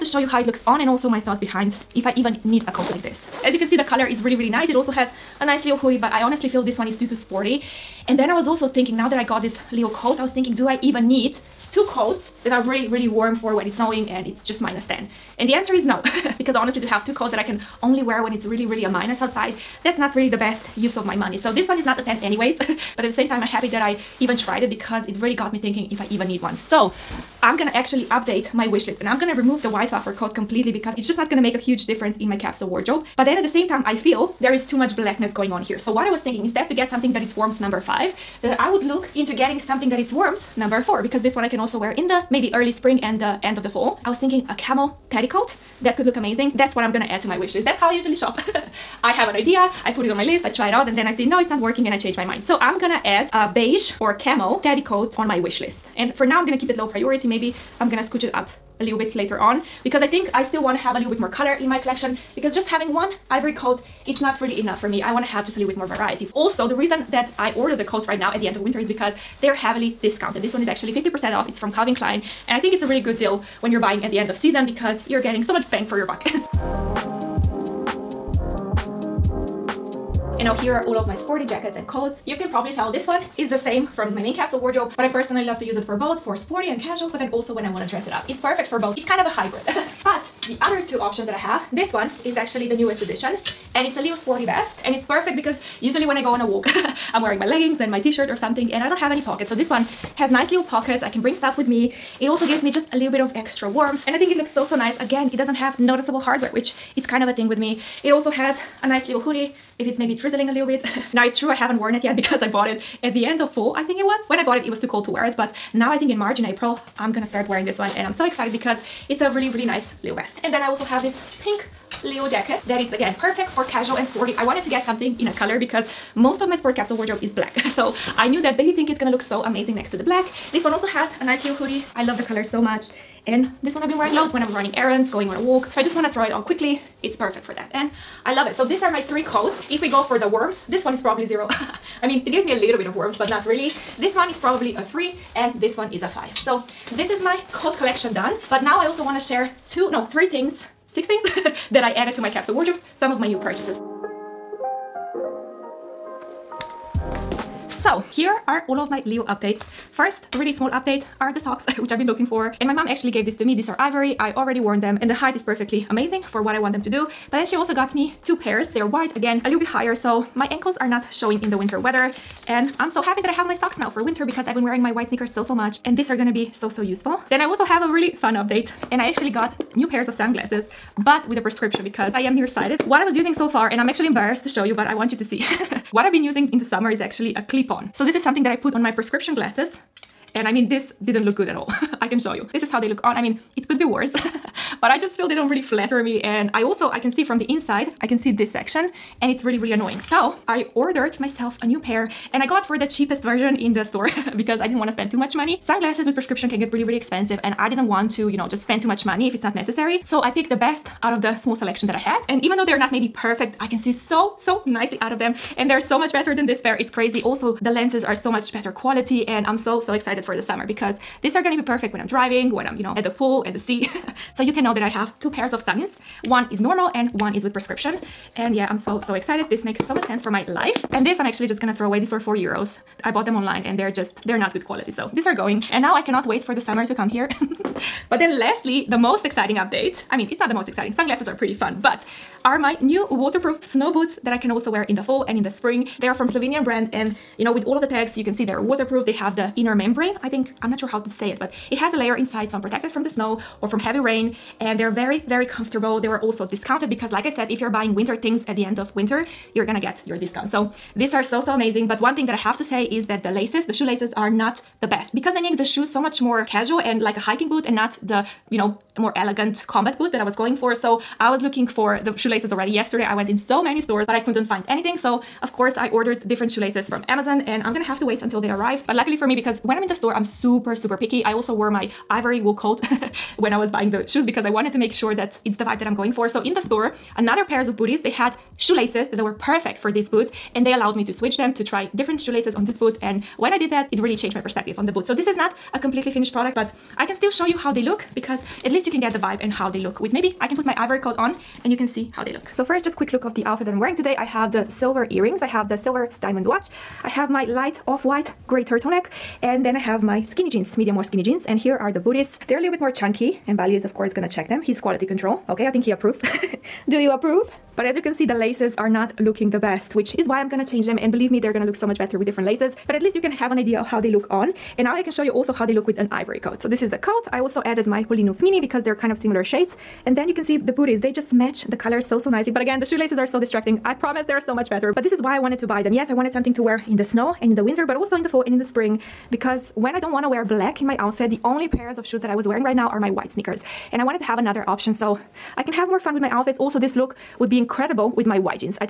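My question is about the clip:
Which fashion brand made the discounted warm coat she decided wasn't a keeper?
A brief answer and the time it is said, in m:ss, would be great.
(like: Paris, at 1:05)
Calvin Klein, at 1:11.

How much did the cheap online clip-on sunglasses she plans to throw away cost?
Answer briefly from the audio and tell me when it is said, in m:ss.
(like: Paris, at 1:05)
4 euros, at 3:52.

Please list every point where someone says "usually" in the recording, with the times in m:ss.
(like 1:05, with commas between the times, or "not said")
0:47, 1:35.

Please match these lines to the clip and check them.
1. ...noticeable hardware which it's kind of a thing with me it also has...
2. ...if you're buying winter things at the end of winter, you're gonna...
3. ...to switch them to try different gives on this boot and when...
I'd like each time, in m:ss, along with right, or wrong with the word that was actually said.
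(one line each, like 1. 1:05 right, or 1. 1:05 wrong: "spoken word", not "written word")
1. 1:45 right
2. 4:17 right
3. 4:51 wrong: "shoelaces", not "gives".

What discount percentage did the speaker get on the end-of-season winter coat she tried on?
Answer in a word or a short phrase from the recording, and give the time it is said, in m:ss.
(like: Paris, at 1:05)
50%, at 1:10.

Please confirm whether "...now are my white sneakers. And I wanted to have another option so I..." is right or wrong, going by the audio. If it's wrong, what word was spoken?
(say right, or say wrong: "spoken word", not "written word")
right.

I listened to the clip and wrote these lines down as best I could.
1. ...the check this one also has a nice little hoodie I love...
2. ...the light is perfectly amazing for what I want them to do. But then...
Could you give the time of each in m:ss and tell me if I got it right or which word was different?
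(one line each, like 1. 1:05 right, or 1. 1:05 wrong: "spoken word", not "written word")
1. 2:09 wrong: "black", not "check"
2. 2:45 wrong: "height", not "light".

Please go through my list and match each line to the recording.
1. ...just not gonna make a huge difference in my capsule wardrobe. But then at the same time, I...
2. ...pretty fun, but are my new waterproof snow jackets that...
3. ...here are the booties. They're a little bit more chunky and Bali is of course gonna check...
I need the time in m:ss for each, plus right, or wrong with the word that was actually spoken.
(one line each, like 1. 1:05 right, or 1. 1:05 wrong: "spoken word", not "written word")
1. 0:31 right
2. 4:01 wrong: "boots", not "jackets"
3. 5:11 right.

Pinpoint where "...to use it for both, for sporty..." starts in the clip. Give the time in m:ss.
1:25.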